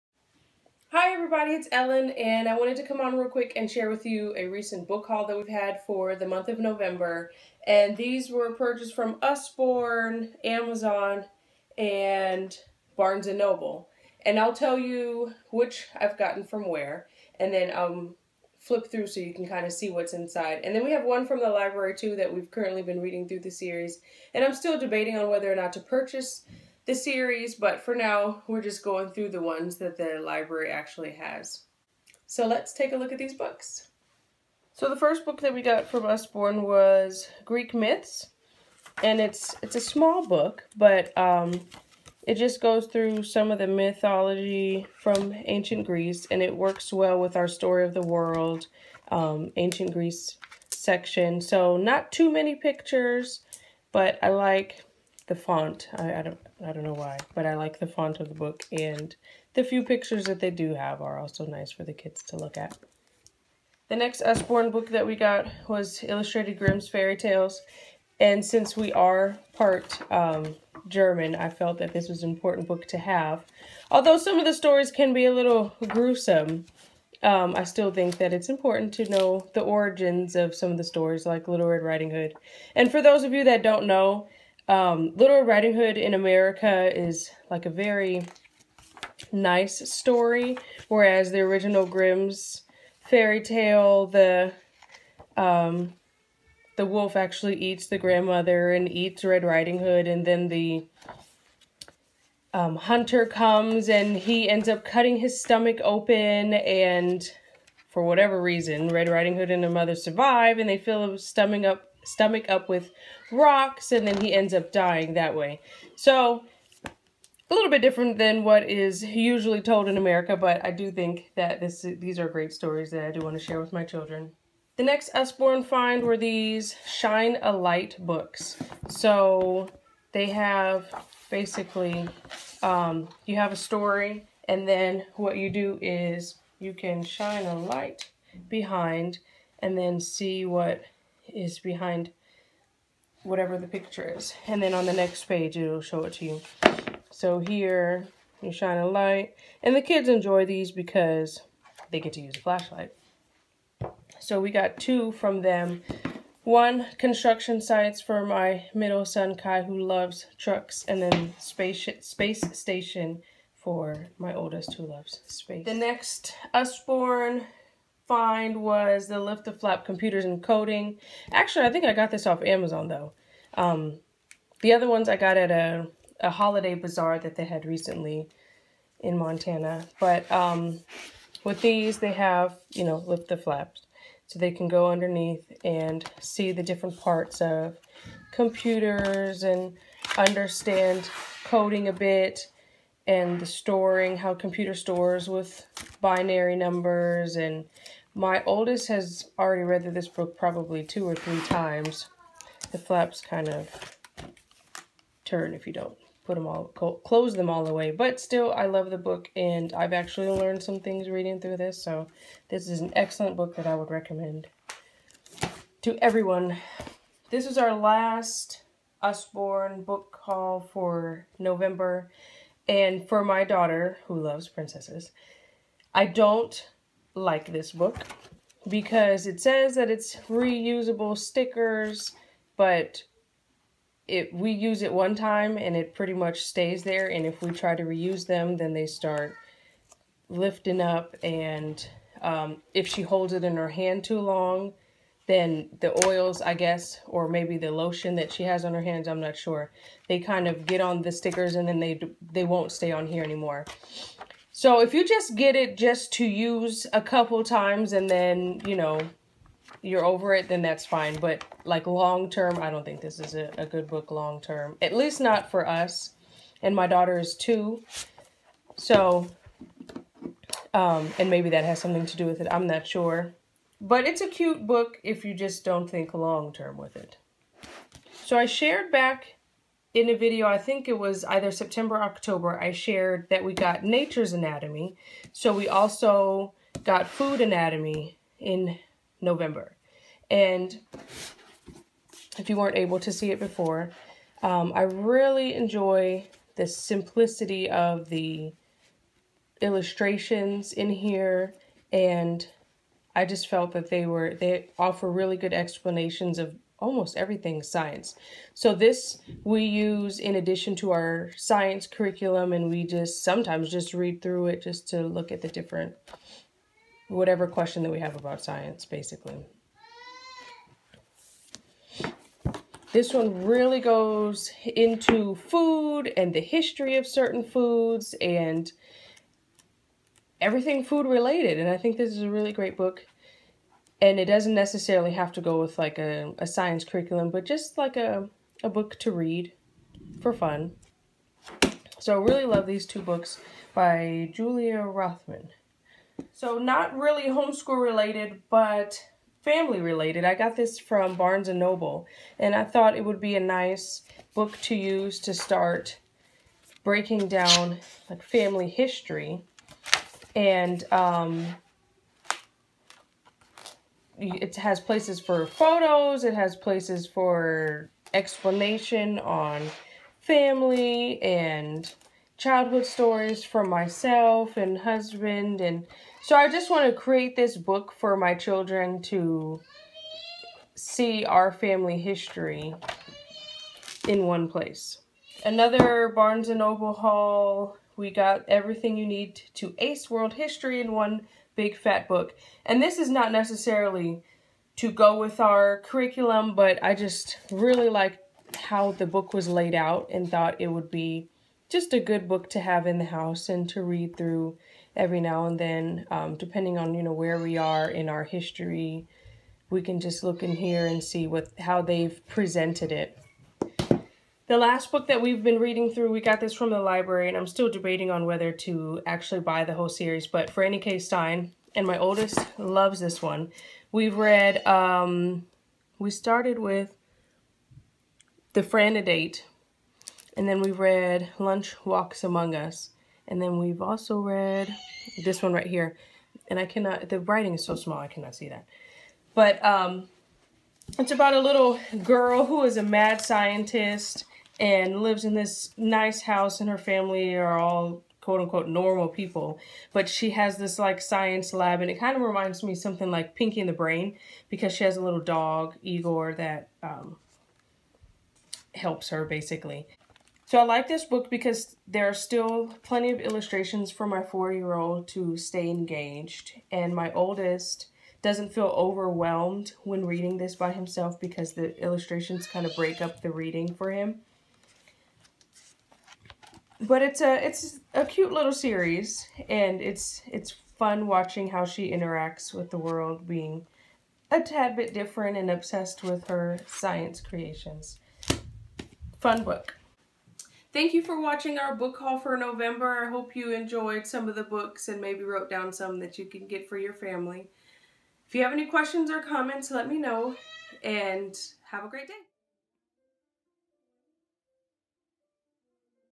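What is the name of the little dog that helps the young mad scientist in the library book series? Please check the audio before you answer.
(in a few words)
Igor.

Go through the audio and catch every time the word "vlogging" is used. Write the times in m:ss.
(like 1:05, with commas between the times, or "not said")
not said.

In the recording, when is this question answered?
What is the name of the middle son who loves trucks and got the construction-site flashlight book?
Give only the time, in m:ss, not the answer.
2:39.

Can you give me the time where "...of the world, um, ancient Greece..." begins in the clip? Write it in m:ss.
0:47.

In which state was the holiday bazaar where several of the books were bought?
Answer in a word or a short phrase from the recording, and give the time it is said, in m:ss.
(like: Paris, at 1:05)
Montana, at 2:59.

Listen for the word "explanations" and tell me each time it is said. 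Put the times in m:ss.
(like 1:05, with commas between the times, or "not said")
5:05, 6:08.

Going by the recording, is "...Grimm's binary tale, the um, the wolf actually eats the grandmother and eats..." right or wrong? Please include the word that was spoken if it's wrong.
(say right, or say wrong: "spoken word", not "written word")
wrong: "fairy", not "binary".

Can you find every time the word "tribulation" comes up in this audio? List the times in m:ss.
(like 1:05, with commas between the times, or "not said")
not said.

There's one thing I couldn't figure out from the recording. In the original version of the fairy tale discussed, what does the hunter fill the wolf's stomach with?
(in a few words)
Rocks.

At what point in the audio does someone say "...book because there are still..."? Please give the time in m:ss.
7:41.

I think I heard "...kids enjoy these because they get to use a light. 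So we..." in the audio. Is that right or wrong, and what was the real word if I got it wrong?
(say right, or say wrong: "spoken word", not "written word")
wrong: "flashlight", not "light".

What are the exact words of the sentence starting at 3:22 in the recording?
The flaps kind of turn if you don't put them all, close them all the way.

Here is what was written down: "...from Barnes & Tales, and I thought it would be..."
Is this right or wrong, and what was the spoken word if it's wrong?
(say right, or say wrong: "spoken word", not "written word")
wrong: "Noble", not "Tales".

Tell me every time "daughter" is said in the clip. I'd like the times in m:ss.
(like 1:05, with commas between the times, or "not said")
3:43, 4:26.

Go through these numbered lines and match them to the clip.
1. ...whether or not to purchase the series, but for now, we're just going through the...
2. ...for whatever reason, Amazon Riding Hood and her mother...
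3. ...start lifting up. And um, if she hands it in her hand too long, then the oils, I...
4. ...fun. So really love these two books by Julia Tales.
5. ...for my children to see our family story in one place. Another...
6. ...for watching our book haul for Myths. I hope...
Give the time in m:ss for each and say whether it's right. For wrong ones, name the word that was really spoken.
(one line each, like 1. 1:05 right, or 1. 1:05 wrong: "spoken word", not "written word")
1. 0:25 right
2. 1:47 wrong: "Red", not "Amazon"
3. 3:58 wrong: "holds", not "hands"
4. 5:40 wrong: "Rothman", not "Tales"
5. 6:17 wrong: "history", not "story"
6. 8:11 wrong: "November", not "Myths".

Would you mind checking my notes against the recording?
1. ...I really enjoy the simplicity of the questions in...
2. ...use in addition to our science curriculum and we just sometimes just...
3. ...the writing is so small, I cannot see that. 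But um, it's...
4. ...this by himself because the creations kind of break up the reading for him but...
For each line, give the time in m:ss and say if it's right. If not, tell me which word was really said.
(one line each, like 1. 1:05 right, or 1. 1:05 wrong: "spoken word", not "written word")
1. 4:54 wrong: "illustrations", not "questions"
2. 5:09 right
3. 7:17 right
4. 7:50 wrong: "illustrations", not "creations".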